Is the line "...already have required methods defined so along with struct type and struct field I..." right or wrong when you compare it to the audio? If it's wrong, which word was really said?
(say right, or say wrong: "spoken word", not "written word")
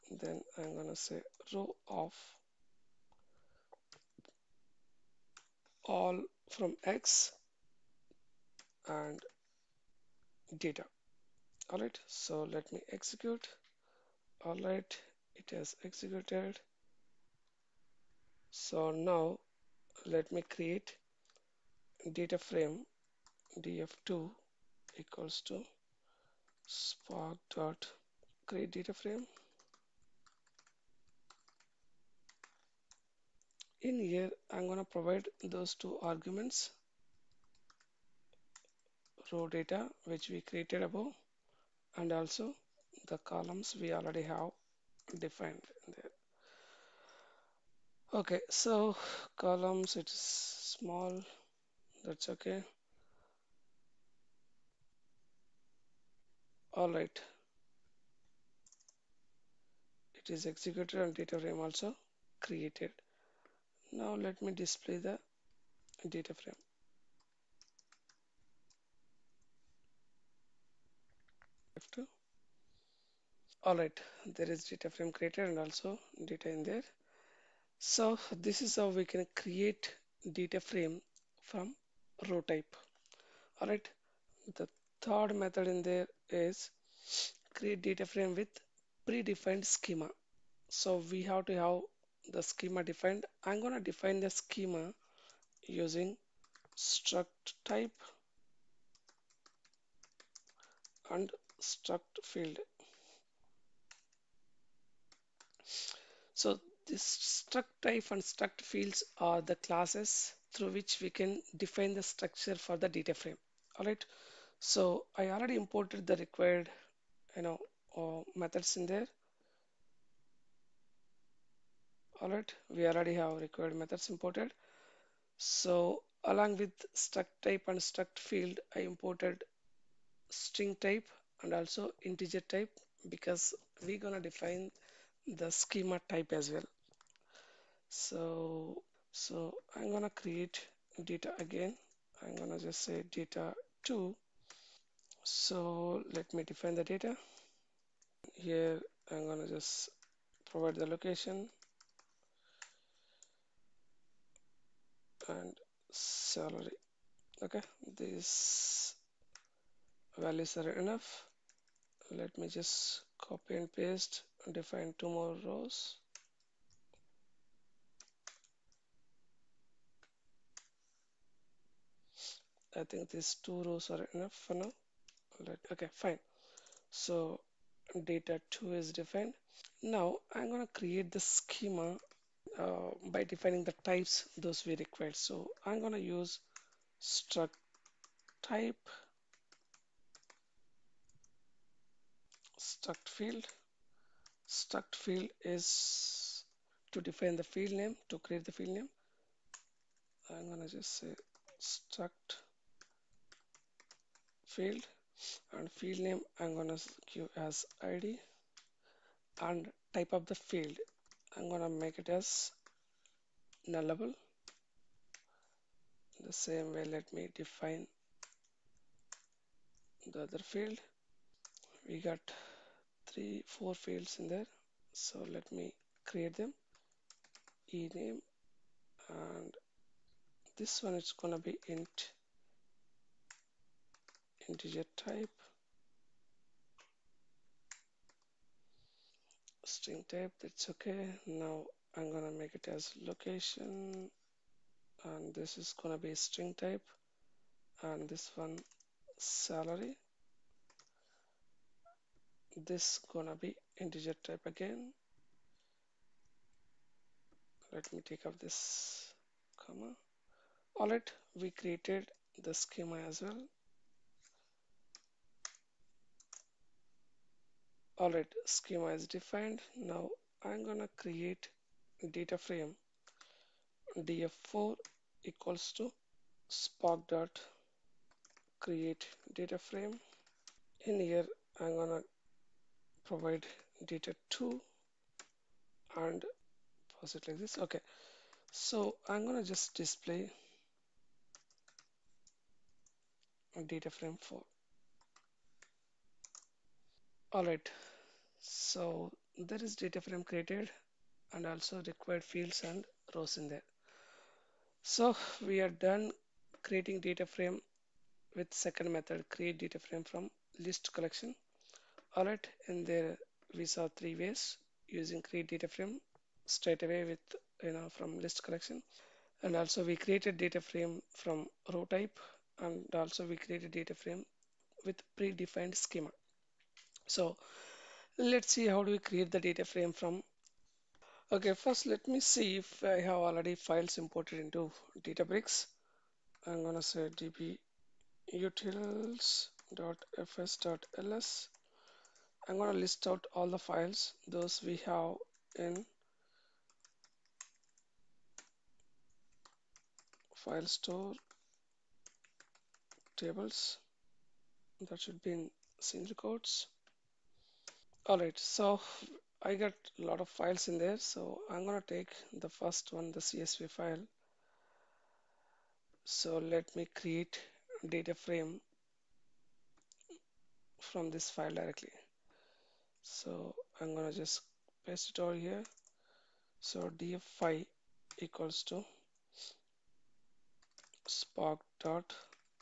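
wrong: "imported", not "defined".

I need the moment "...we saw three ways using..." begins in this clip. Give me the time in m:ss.
5:13.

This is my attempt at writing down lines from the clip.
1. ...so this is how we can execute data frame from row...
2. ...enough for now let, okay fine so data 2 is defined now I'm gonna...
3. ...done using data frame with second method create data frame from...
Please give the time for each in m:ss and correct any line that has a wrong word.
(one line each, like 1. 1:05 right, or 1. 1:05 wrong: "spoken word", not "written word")
1. 1:17 wrong: "create", not "execute"
2. 2:54 right
3. 5:05 wrong: "creating", not "using".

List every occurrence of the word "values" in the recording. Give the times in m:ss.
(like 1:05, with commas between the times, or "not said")
2:40.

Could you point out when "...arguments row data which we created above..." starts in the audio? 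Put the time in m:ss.
0:36.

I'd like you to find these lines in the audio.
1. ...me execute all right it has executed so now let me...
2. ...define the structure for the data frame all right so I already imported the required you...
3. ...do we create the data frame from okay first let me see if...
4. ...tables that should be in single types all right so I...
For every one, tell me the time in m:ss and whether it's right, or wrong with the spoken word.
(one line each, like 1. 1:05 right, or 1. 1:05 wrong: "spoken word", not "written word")
1. 0:12 right
2. 1:51 right
3. 5:28 right
4. 5:53 wrong: "quotes", not "types".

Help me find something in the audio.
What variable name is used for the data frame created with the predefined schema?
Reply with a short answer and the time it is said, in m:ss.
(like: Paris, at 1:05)
df4, at 4:33.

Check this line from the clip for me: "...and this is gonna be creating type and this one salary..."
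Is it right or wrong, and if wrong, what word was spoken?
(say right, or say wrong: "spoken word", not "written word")
wrong: "string", not "creating".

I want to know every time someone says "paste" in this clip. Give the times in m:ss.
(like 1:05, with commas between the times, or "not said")
2:43, 6:14.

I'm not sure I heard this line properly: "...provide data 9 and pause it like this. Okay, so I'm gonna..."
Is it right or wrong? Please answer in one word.
wrong.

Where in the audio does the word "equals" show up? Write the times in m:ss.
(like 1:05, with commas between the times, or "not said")
0:24, 4:35, 6:18.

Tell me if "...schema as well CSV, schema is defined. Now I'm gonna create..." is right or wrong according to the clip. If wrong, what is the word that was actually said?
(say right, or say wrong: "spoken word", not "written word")
wrong: "Alright", not "CSV".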